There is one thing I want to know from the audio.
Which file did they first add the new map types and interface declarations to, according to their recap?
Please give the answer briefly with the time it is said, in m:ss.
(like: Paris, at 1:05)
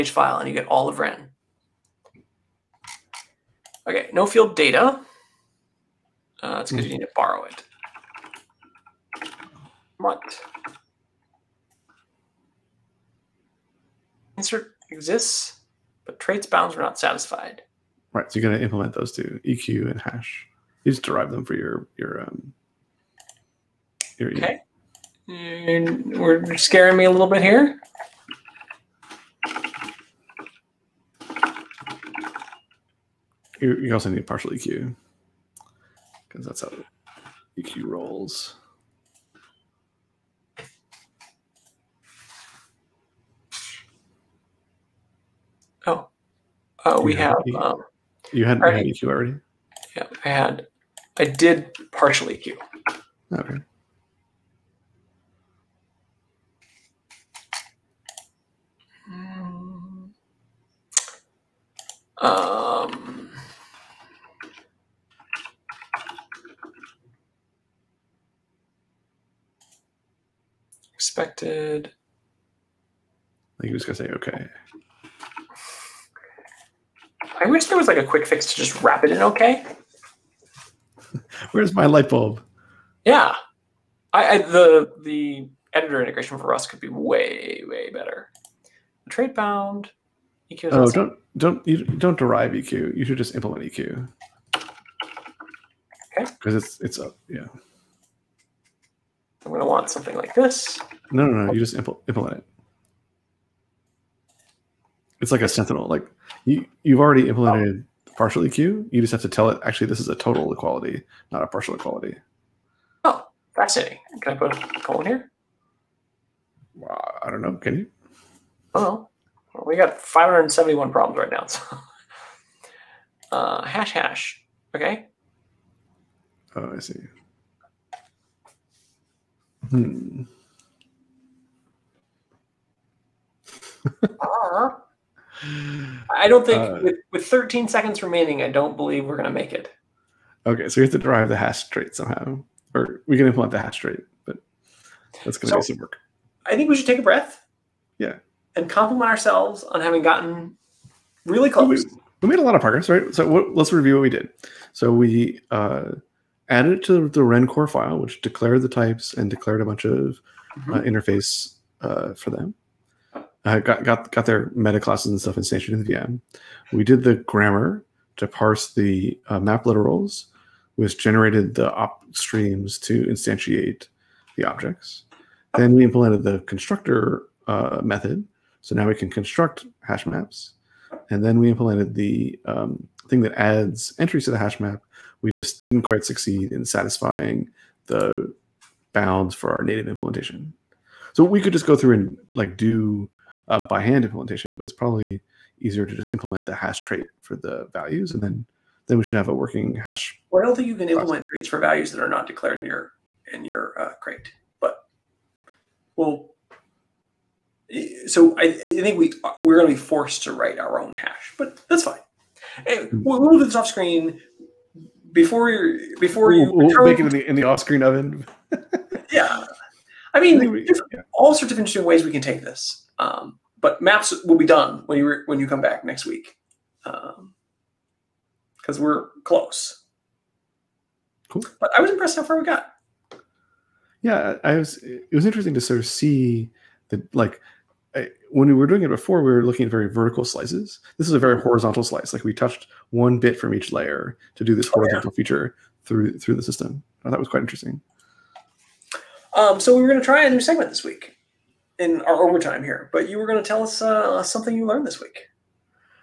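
Wren core file, at 2:37.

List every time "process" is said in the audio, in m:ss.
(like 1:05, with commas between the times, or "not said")
3:20.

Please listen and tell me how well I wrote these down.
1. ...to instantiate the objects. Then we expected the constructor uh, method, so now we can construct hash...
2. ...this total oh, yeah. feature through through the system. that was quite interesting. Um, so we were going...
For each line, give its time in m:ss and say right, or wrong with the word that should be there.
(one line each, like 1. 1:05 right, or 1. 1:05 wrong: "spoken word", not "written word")
1. 2:52 wrong: "implemented", not "expected"
2. 4:04 wrong: "horizontal", not "total".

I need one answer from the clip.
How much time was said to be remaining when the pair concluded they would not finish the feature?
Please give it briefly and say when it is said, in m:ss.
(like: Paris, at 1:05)
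13 seconds, at 2:17.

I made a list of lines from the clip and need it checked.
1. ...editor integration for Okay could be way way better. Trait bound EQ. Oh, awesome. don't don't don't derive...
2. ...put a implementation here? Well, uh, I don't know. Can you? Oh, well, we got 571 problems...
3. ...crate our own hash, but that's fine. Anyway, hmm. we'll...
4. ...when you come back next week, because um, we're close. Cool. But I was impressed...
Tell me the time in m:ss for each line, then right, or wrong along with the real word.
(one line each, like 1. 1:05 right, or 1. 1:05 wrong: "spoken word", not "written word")
1. 1:25 wrong: "Rust", not "Okay"
2. 1:54 wrong: "colon", not "implementation"
3. 3:30 wrong: "write", not "crate"
4. 3:45 right.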